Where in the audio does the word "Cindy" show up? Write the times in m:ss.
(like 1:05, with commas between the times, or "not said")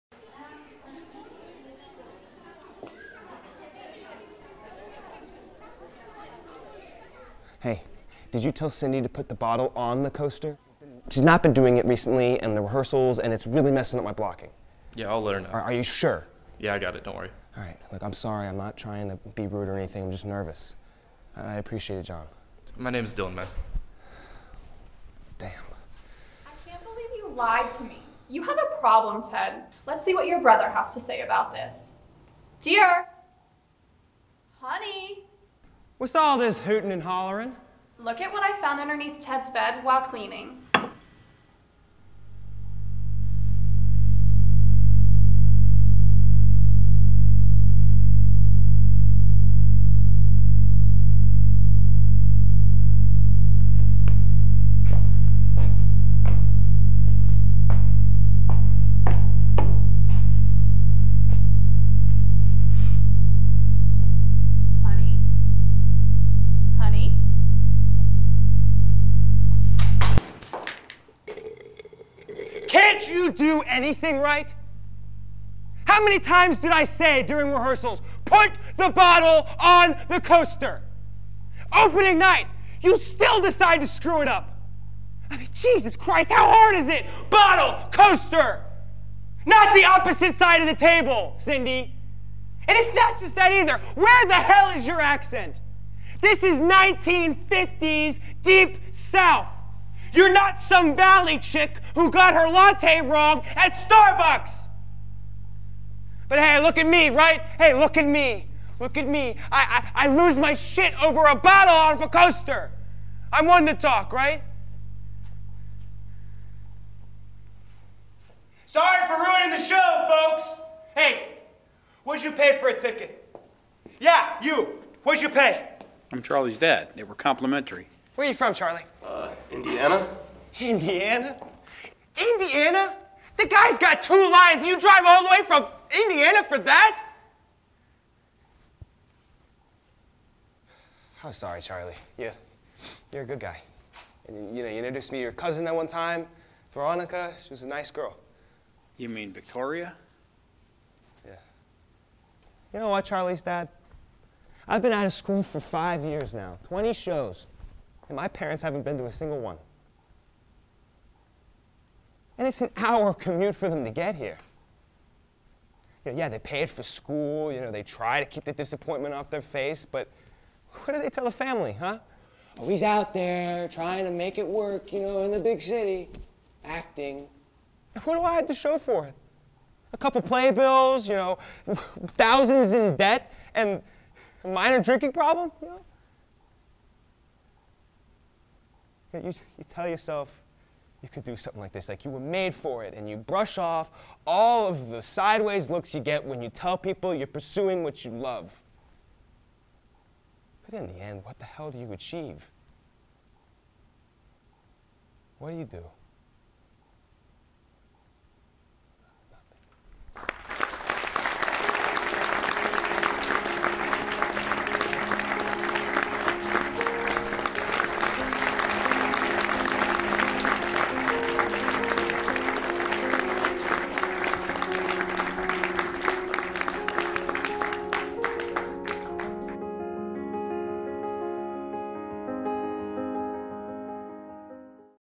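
0:08, 1:31.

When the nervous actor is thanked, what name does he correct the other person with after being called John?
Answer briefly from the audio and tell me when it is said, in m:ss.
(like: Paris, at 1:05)
Dylan, at 0:22.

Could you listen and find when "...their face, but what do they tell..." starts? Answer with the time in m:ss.
2:49.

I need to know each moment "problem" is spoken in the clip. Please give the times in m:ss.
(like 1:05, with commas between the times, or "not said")
0:28, 3:05.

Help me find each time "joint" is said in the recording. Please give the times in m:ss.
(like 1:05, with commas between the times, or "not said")
not said.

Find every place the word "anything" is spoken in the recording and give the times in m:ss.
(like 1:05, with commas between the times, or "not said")
0:19, 1:13.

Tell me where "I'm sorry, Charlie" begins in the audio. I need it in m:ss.
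2:21.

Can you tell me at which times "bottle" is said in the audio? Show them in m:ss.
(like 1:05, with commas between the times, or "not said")
0:09, 1:18, 1:27, 1:51.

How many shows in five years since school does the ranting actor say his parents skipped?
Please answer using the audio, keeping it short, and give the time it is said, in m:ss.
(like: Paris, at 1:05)
20, at 2:36.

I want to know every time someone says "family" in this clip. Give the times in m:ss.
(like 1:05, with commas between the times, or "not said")
2:51.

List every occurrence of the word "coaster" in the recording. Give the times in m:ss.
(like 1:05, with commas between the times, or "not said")
0:10, 1:20, 1:27, 1:52.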